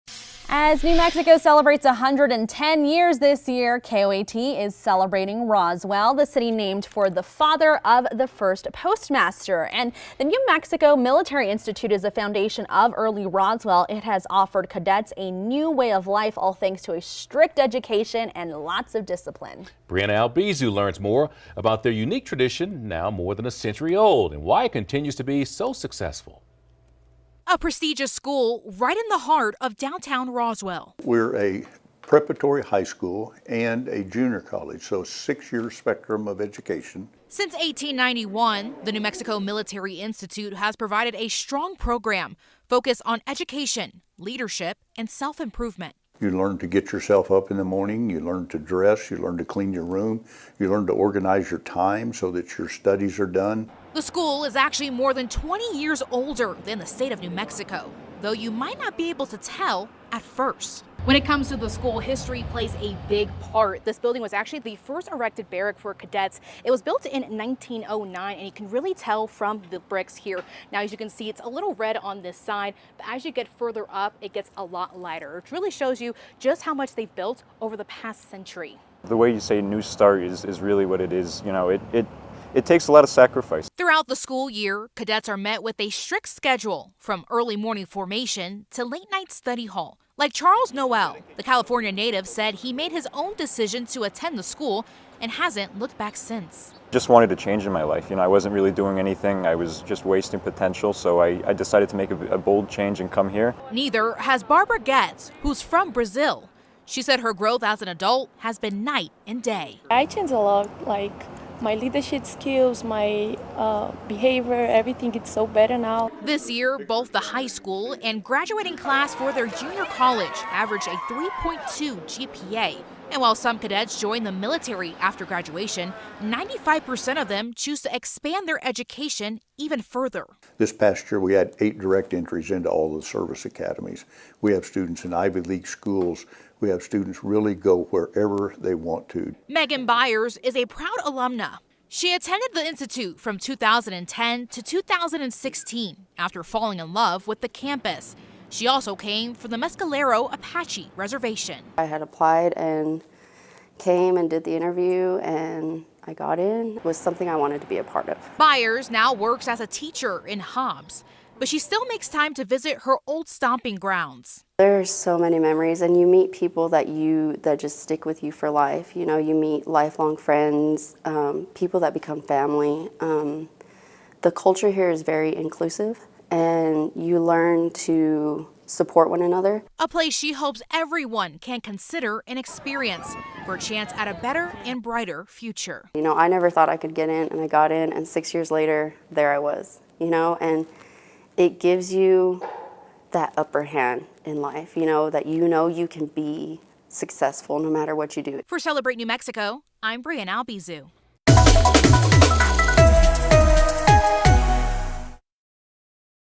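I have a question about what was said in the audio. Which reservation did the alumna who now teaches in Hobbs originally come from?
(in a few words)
Mescalero Apache Reservation.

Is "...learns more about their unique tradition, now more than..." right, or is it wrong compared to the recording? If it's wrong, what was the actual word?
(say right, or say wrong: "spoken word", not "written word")
right.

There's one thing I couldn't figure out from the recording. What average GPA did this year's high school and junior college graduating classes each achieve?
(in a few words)
3.2.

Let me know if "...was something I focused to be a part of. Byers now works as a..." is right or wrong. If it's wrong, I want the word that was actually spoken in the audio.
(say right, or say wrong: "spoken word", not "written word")
wrong: "wanted", not "focused".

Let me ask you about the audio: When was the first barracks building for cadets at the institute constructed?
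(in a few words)
1909.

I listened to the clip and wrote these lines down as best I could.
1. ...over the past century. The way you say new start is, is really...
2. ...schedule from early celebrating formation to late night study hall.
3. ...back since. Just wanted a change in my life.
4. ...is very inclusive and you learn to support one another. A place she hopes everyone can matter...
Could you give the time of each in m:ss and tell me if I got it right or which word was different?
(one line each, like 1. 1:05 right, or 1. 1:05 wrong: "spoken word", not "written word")
1. 1:17 right
2. 1:26 wrong: "morning", not "celebrating"
3. 1:35 right
4. 2:54 wrong: "consider", not "matter".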